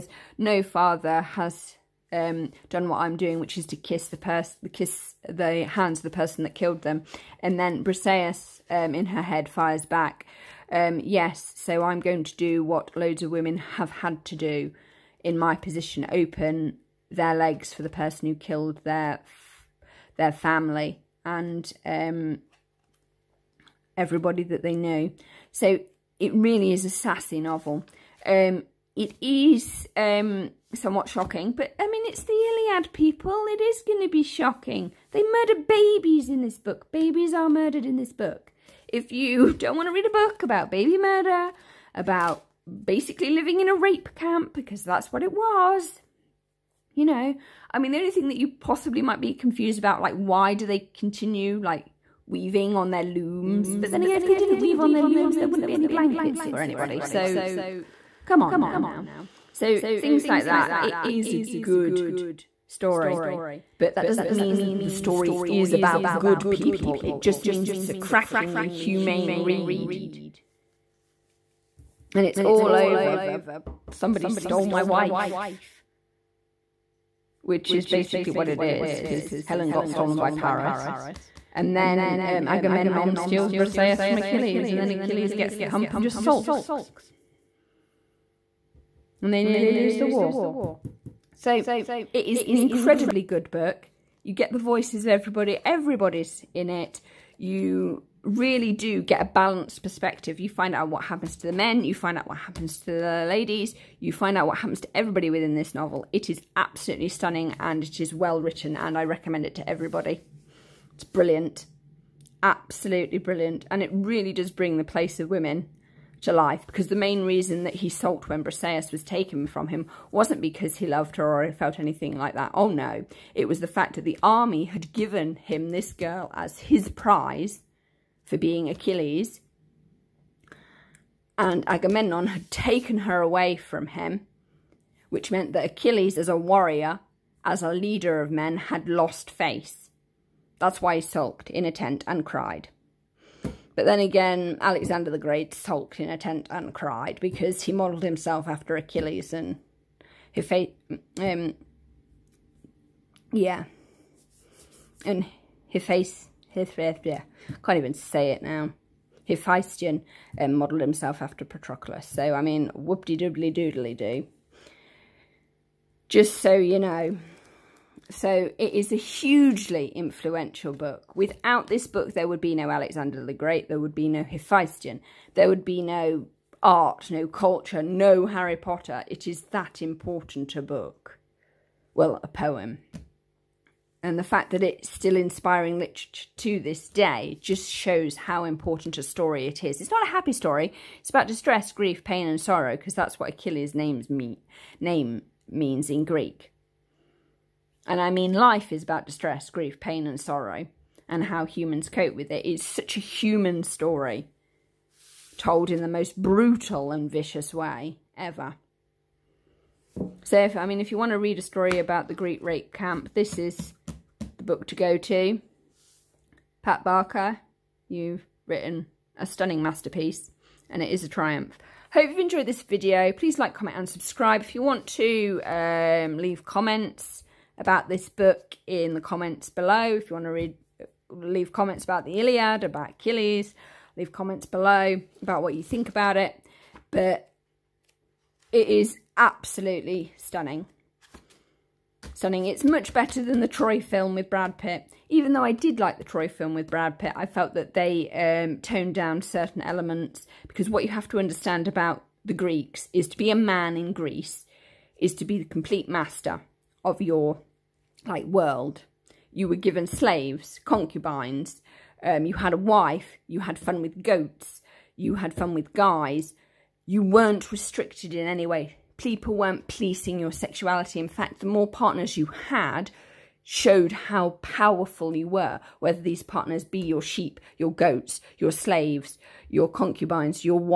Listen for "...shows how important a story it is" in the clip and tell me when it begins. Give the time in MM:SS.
03:07.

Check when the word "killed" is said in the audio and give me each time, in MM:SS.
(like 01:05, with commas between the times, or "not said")
00:06, 00:18.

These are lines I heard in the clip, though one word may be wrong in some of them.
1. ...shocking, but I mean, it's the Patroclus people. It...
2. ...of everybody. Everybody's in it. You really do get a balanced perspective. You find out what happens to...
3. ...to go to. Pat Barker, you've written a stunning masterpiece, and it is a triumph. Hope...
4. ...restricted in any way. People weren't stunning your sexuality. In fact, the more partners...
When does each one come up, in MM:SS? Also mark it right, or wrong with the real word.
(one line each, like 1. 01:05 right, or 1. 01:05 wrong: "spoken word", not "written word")
1. 00:31 wrong: "Iliad", not "Patroclus"
2. 01:35 right
3. 03:34 right
4. 04:27 wrong: "policing", not "stunning".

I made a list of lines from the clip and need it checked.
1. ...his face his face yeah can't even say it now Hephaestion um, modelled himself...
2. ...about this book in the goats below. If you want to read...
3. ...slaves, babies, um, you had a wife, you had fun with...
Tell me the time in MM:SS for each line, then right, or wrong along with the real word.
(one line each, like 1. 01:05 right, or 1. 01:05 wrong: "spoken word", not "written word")
1. 02:35 right
2. 03:47 wrong: "comments", not "goats"
3. 04:19 wrong: "concubines", not "babies".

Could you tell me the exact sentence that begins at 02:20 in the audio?
That's why he sulked in a tent and cried.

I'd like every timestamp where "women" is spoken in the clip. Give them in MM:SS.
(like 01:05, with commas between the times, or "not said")
00:13, 01:55.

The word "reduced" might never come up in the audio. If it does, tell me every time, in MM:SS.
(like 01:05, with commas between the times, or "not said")
not said.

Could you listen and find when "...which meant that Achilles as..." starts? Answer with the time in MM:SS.
02:15.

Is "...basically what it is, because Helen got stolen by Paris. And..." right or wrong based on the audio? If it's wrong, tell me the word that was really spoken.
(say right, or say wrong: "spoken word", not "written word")
right.